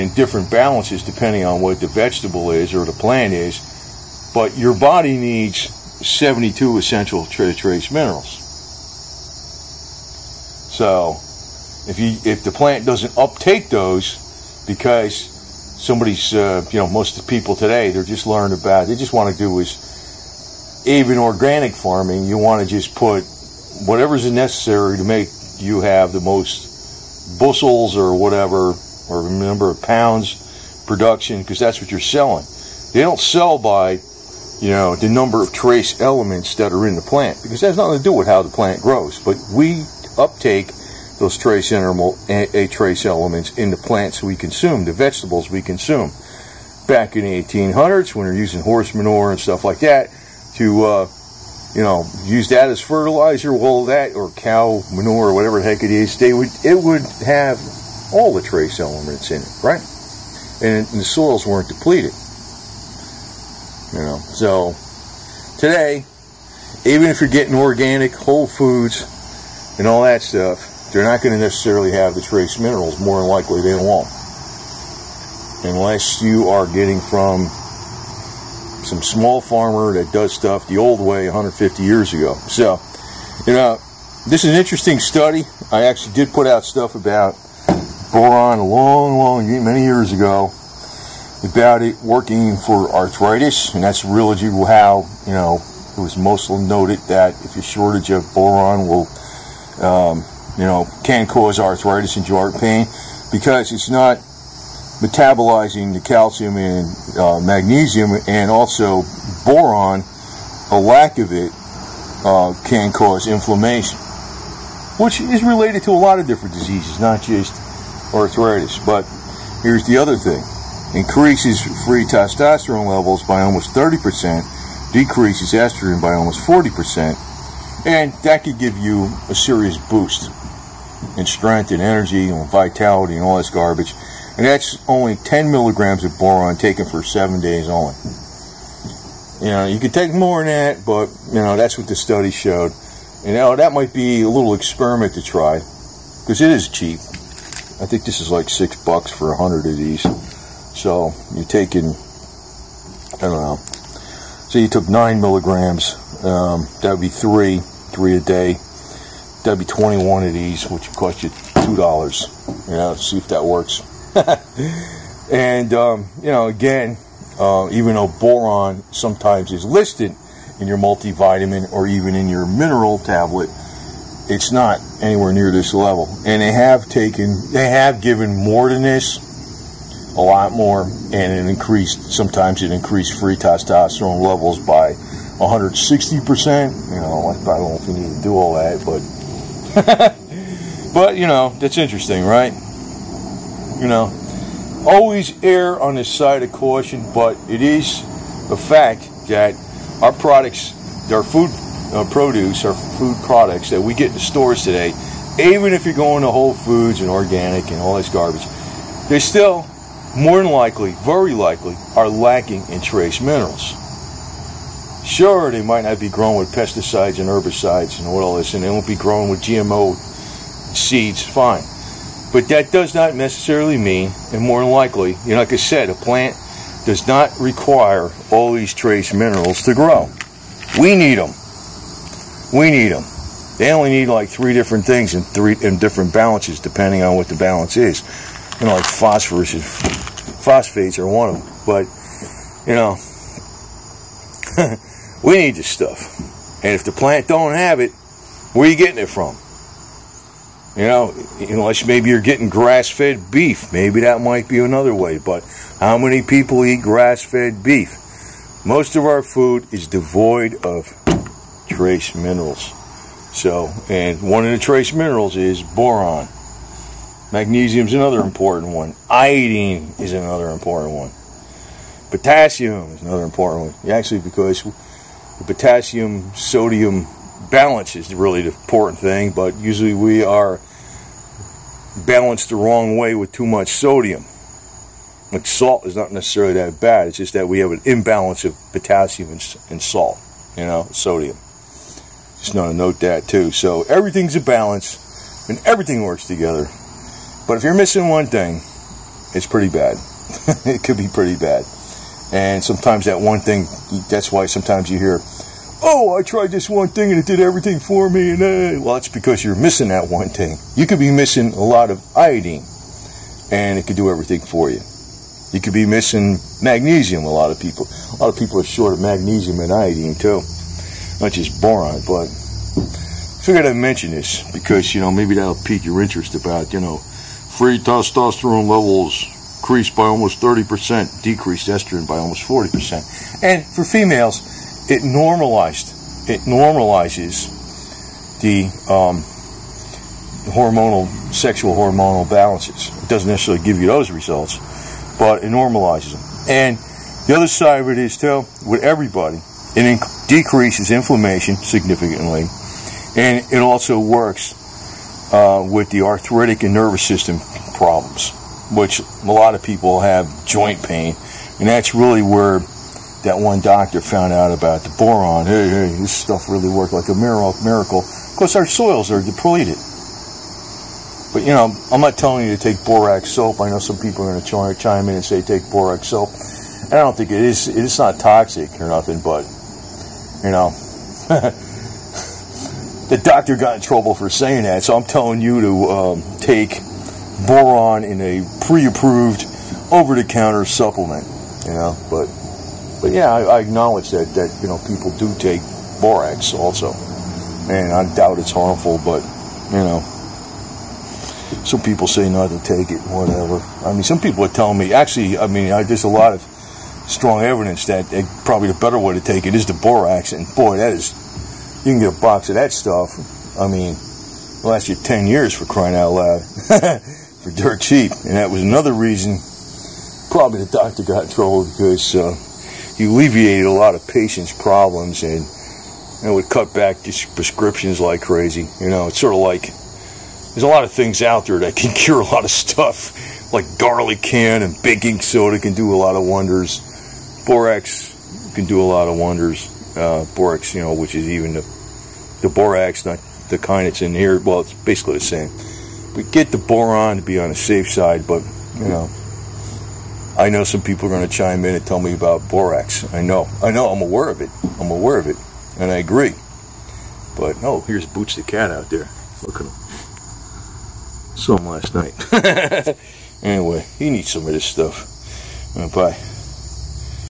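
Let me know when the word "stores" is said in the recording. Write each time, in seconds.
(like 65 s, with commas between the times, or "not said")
204 s.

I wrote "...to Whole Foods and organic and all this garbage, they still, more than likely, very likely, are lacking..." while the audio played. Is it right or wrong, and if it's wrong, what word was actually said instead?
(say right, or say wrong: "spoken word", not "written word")
right.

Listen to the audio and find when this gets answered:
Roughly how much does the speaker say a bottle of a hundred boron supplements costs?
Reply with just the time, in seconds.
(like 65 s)
148 s.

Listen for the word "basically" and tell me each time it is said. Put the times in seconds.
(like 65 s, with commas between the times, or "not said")
444 s.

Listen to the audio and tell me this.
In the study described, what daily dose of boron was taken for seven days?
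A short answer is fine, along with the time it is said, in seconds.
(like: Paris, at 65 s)
10 milligrams, at 135 s.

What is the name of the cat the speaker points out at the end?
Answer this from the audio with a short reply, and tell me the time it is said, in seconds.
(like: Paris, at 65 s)
Boots, at 458 s.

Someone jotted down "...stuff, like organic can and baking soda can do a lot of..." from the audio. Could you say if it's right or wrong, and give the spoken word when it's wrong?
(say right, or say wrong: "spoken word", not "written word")
wrong: "garlic", not "organic".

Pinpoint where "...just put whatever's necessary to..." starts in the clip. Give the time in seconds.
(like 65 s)
22 s.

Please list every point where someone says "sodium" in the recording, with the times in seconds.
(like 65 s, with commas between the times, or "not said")
276 s, 283 s, 290 s.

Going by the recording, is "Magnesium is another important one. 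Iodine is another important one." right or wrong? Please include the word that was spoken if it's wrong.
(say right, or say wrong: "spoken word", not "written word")
right.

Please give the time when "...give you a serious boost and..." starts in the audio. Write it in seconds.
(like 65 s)
128 s.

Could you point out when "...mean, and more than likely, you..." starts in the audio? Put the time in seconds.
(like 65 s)
223 s.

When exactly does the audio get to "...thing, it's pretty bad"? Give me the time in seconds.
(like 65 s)
298 s.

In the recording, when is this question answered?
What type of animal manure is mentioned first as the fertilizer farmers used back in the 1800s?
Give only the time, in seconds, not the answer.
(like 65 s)
48 s.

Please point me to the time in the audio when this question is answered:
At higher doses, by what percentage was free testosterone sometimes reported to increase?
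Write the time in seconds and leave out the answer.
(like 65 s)
185 s.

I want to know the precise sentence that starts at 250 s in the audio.
You know, unless maybe you're getting grass-fed beef, maybe that might be another way.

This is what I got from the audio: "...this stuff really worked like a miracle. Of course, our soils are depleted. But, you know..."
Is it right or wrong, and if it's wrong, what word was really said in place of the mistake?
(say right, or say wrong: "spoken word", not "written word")
right.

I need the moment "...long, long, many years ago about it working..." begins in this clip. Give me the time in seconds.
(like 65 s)
88 s.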